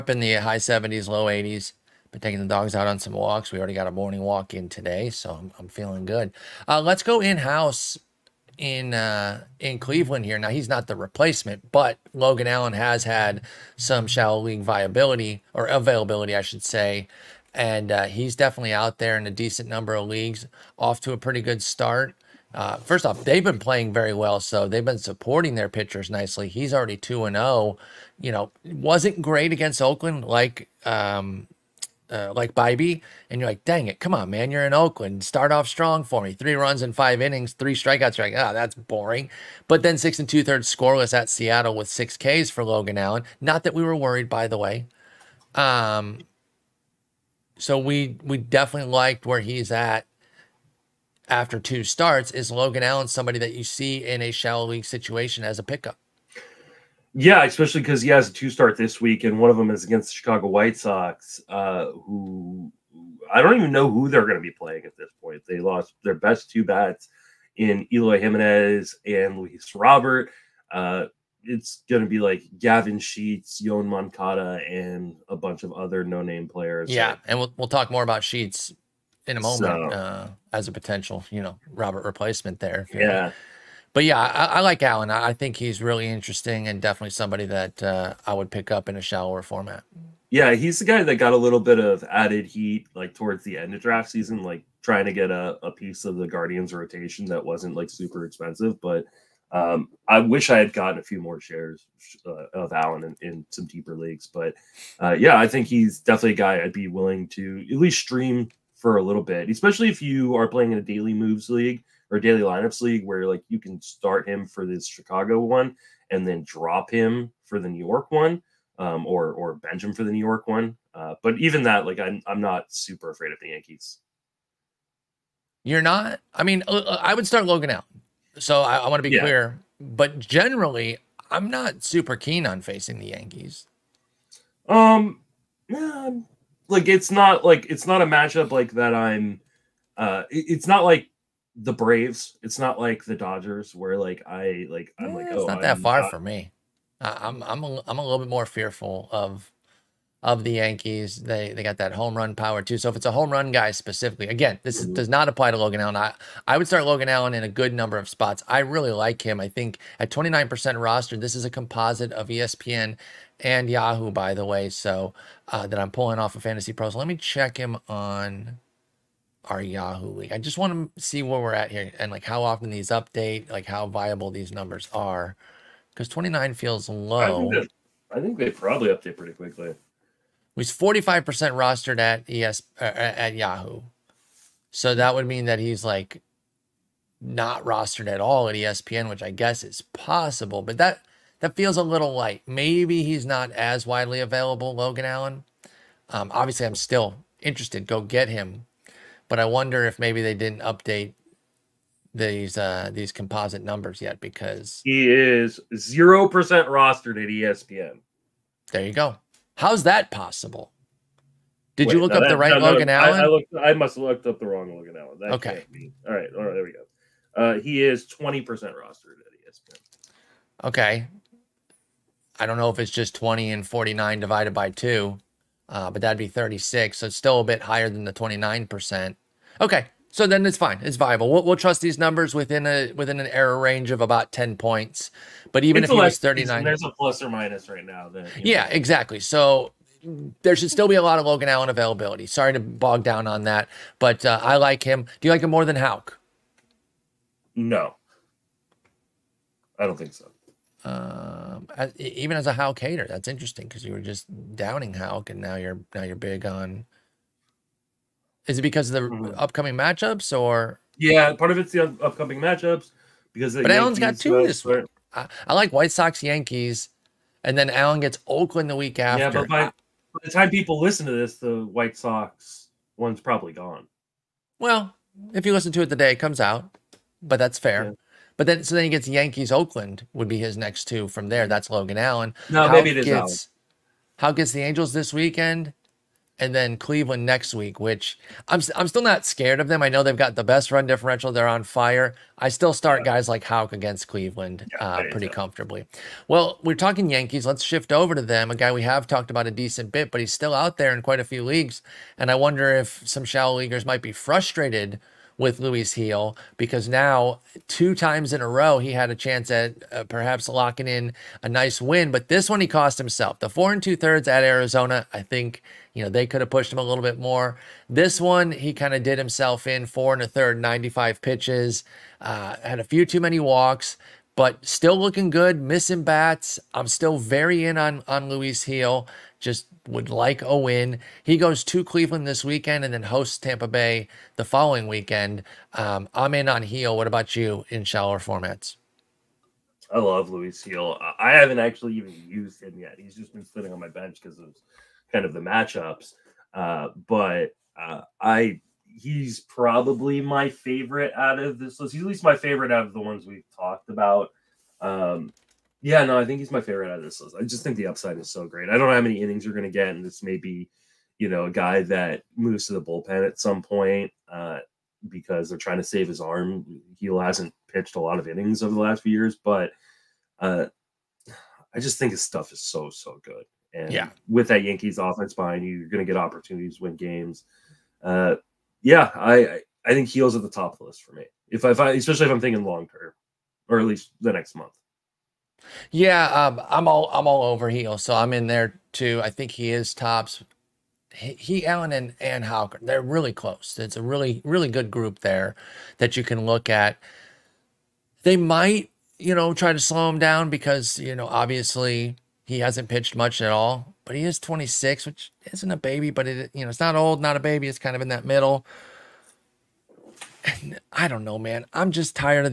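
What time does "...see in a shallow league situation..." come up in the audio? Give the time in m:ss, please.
0:53.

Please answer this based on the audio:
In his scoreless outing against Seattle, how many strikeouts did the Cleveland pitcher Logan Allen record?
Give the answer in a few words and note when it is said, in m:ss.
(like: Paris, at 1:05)
6, at 0:41.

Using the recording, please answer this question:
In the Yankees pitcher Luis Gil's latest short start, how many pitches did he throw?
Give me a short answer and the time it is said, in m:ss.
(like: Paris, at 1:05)
95, at 5:20.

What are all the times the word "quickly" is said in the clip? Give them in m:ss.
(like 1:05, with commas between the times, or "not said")
2:59.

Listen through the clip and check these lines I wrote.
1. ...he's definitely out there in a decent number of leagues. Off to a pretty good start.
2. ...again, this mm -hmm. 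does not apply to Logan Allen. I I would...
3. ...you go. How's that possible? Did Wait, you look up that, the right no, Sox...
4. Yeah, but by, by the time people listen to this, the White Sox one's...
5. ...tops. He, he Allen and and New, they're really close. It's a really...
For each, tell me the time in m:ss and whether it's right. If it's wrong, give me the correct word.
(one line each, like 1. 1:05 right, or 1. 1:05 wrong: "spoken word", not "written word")
1. 0:18 right
2. 2:34 right
3. 3:28 wrong: "Logan", not "Sox"
4. 4:29 right
5. 6:29 wrong: "Hawker", not "New".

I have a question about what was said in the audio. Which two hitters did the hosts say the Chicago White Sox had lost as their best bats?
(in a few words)
Eloy Jimenez and Luis Robert.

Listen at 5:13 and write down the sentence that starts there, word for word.
The four and two thirds at Arizona, I think you know they could have pushed him a little bit more.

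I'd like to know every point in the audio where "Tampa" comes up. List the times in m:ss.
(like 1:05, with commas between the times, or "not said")
5:33.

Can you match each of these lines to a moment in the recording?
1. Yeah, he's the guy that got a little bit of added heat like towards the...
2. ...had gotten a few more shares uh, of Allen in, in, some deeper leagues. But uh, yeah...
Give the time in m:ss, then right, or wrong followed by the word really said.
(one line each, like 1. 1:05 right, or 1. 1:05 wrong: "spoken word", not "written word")
1. 1:30 right
2. 1:40 right.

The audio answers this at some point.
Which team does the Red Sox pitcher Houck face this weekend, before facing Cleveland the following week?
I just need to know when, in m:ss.
4:44.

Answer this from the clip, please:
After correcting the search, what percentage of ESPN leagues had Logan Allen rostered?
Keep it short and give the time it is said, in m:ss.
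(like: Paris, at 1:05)
20%, at 3:38.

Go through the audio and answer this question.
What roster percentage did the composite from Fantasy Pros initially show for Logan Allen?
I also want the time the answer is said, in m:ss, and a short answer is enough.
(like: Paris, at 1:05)
29%, at 2:40.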